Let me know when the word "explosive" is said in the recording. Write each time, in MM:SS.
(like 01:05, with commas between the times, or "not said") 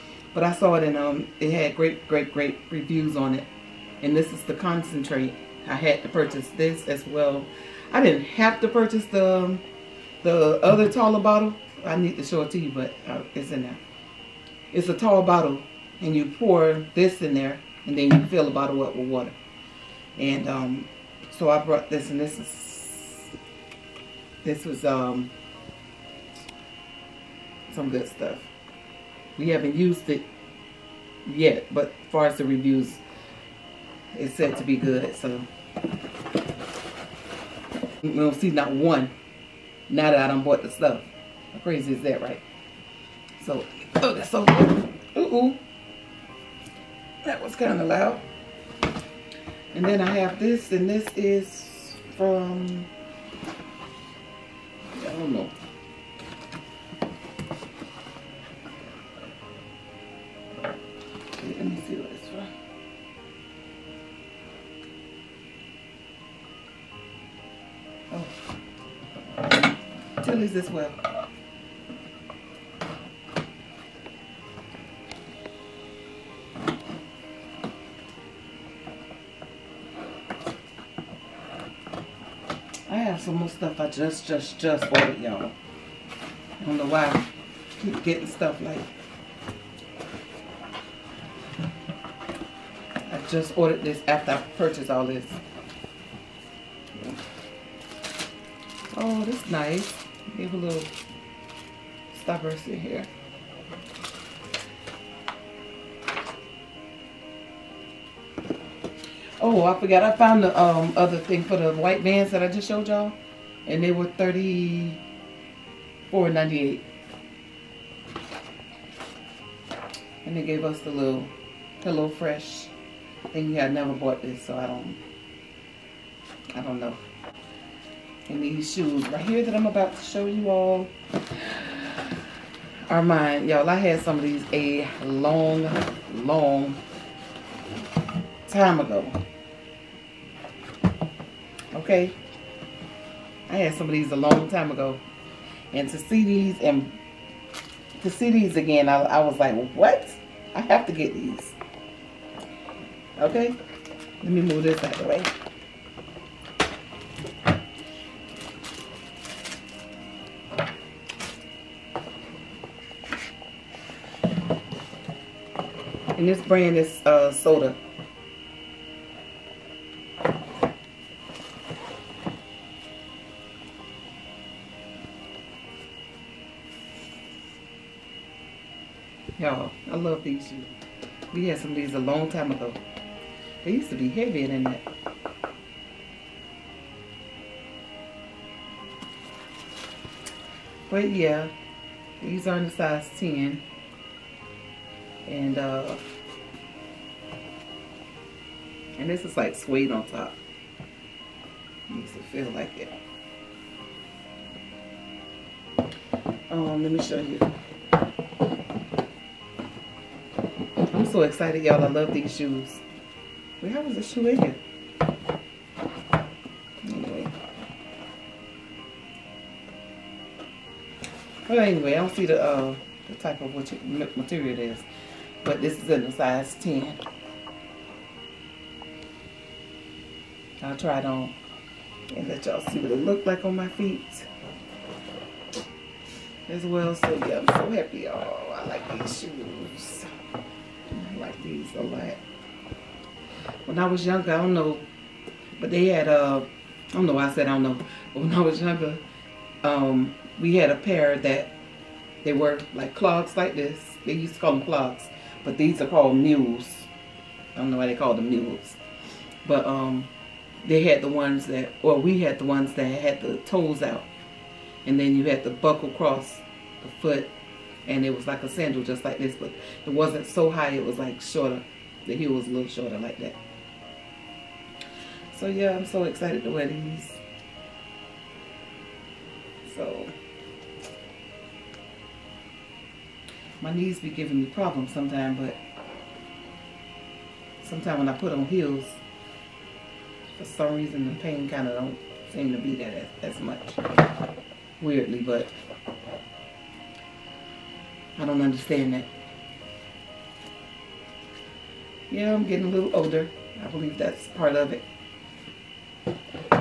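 not said.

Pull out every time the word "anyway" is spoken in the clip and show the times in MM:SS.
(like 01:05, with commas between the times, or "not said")
03:36, 03:41.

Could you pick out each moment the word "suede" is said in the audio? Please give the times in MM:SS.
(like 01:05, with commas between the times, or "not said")
03:19.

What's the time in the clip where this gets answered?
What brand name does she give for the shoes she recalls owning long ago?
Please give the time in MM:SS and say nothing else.
02:47.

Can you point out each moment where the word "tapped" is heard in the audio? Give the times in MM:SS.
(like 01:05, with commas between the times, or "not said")
not said.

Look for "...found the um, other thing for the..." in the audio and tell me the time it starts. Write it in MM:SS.
01:50.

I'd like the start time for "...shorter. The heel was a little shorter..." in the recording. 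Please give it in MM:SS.
04:31.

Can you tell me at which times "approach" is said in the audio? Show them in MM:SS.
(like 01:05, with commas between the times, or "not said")
not said.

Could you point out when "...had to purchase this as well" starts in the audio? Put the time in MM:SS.
00:05.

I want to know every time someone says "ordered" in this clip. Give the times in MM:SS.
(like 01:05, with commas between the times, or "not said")
01:24, 01:33.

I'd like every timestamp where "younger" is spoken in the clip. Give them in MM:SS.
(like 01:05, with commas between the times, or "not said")
04:04, 04:08.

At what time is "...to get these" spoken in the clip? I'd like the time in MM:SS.
02:30.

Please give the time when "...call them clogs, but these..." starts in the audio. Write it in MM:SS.
04:14.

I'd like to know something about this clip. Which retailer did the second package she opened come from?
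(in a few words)
Tilly's.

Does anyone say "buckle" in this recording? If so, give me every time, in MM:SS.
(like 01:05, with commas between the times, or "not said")
04:25.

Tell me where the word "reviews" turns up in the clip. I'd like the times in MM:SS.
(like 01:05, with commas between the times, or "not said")
00:02, 00:32.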